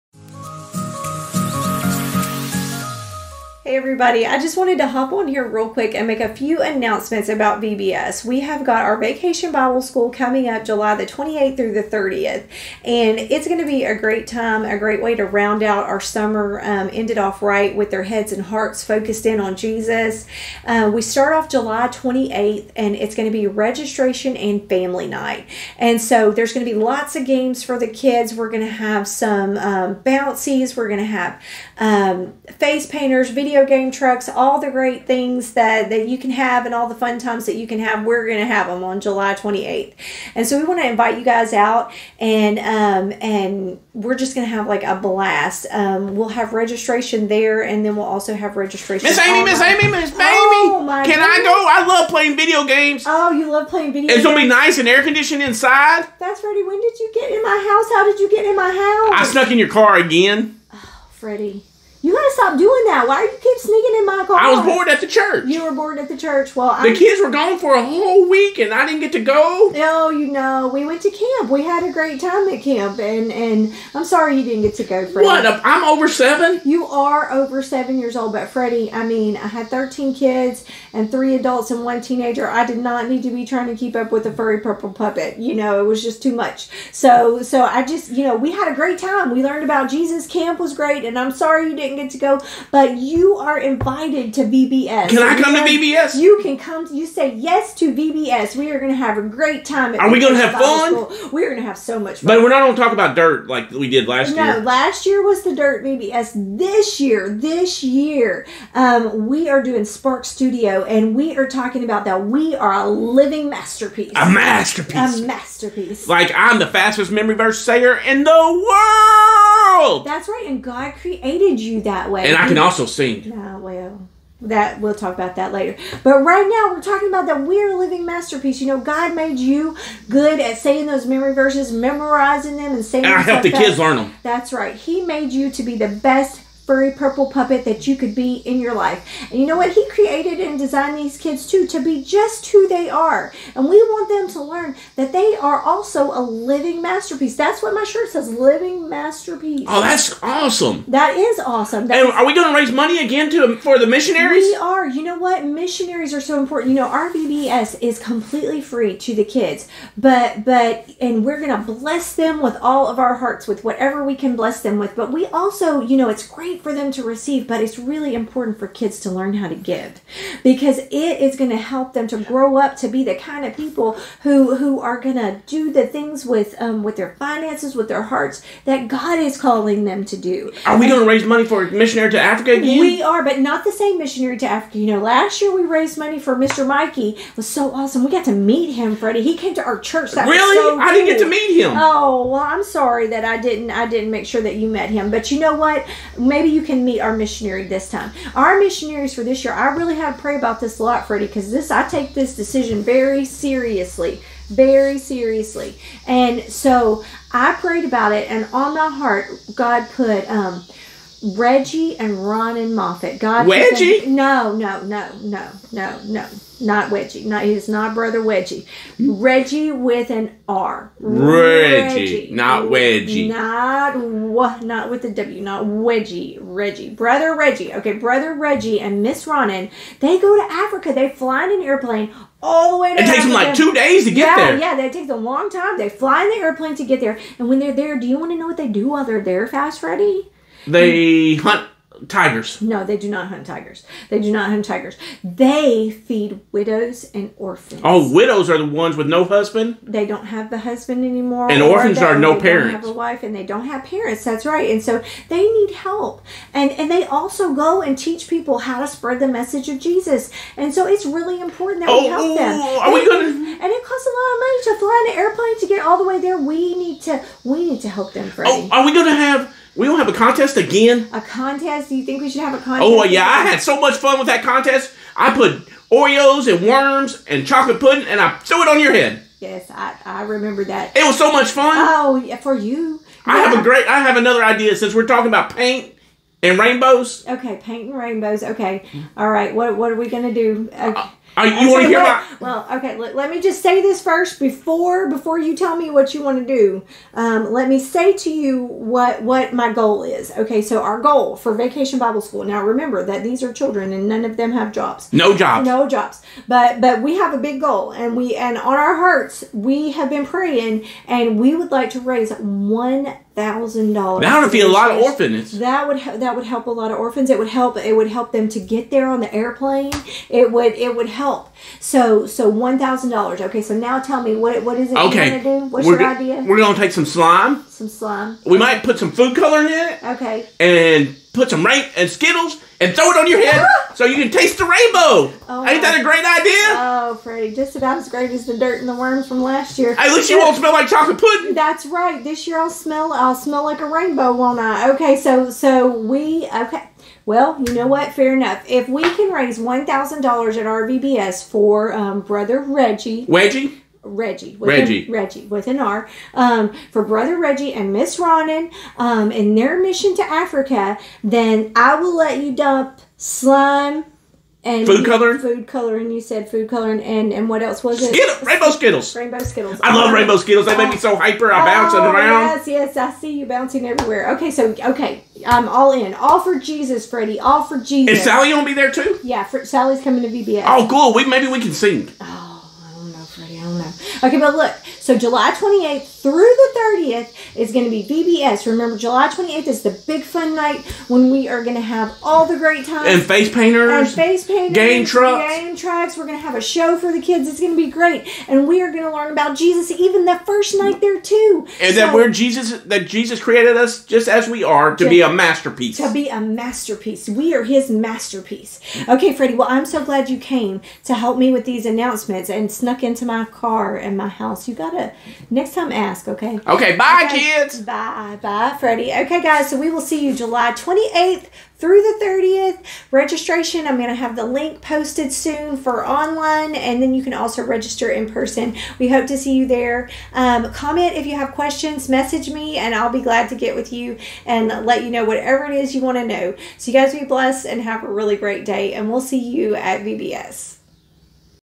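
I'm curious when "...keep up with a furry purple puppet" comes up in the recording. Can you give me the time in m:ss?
1:23.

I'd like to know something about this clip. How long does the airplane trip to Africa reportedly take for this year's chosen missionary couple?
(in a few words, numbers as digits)
2 days.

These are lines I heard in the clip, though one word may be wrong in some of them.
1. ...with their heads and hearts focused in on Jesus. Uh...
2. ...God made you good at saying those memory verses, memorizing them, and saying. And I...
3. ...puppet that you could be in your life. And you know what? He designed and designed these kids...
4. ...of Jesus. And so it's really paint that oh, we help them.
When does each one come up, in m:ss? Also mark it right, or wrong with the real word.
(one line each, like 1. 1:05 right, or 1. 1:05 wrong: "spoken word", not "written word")
1. 0:17 right
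2. 2:08 right
3. 2:17 wrong: "created", not "designed"
4. 4:19 wrong: "important", not "paint".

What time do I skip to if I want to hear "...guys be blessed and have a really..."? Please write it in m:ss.
7:16.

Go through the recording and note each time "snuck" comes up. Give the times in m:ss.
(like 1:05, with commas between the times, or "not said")
0:59, 6:52.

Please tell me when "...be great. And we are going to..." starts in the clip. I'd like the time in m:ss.
6:37.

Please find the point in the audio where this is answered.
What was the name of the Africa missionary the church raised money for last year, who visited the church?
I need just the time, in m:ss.
3:06.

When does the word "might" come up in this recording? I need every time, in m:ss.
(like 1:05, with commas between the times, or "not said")
5:28.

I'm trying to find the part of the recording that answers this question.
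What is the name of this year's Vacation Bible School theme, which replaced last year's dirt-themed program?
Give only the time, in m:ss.
1:49.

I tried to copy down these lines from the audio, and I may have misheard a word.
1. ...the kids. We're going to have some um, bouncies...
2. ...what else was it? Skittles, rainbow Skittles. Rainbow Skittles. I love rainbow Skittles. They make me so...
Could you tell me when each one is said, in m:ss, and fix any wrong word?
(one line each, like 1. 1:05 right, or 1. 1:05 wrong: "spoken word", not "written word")
1. 0:27 right
2. 6:07 right.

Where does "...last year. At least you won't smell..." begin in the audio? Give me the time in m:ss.
5:39.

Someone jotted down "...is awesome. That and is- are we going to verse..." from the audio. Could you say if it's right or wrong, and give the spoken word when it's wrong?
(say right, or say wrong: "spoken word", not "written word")
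wrong: "raise", not "verse".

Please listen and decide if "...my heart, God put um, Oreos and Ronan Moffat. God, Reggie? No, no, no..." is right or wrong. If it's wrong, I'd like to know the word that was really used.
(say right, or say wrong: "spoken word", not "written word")
wrong: "Reggie", not "Oreos".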